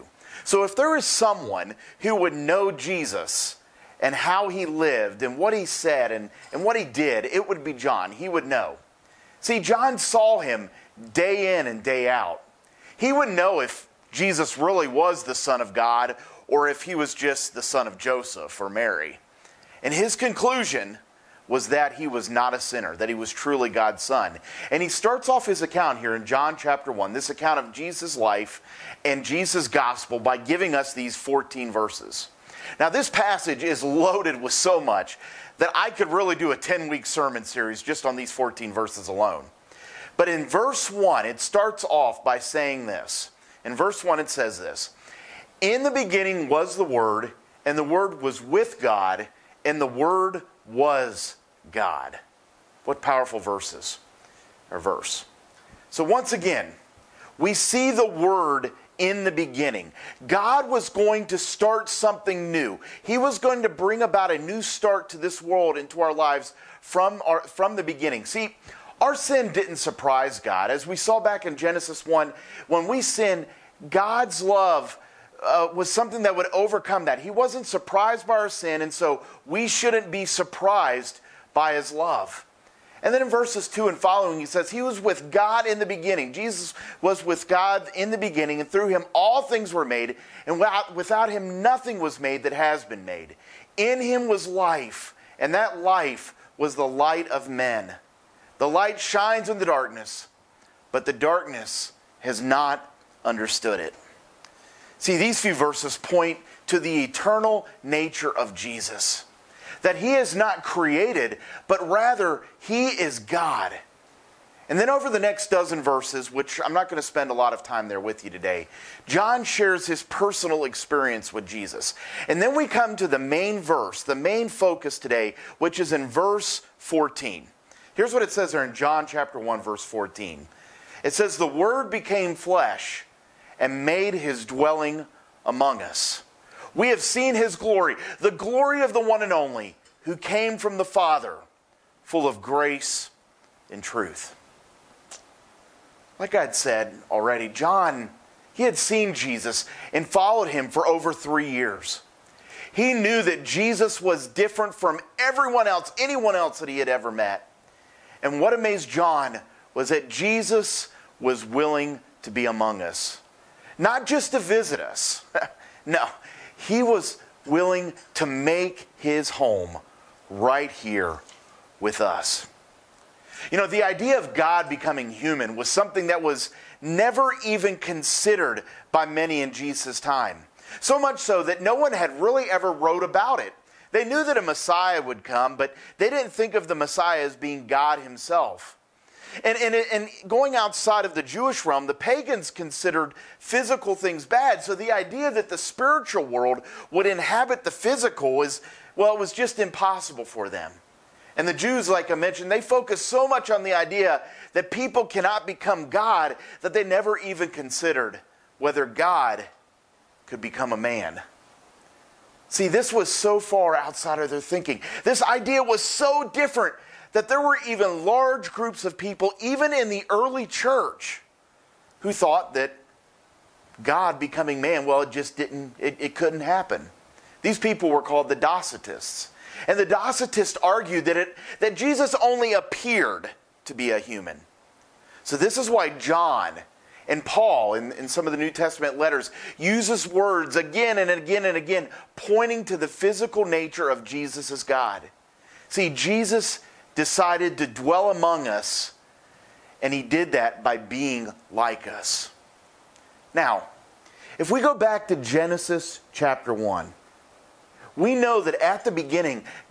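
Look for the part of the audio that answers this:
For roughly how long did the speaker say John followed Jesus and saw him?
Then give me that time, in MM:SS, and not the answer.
02:30.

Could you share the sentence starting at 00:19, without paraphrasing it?
And his conclusion was that he was not a sinner, that he was truly God's son.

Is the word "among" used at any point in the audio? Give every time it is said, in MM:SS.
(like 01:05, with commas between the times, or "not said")
02:15, 02:42, 04:08.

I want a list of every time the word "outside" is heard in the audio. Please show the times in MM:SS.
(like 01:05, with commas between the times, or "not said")
03:10, 03:33.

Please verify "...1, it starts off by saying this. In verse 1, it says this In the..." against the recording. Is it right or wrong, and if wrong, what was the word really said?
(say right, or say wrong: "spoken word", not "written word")
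right.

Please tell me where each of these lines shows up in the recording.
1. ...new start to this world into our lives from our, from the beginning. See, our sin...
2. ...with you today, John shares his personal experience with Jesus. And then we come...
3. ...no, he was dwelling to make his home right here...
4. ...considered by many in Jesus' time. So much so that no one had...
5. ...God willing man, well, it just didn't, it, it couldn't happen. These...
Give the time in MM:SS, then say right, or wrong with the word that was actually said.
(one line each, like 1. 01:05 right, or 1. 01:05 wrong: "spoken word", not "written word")
1. 01:04 right
2. 01:57 right
3. 02:45 wrong: "willing", not "dwelling"
4. 02:57 right
5. 03:43 wrong: "becoming", not "willing".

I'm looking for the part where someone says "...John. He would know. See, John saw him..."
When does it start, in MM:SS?
00:07.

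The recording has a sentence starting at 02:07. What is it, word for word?
Here's what it says there in John chapter 1 verse 14.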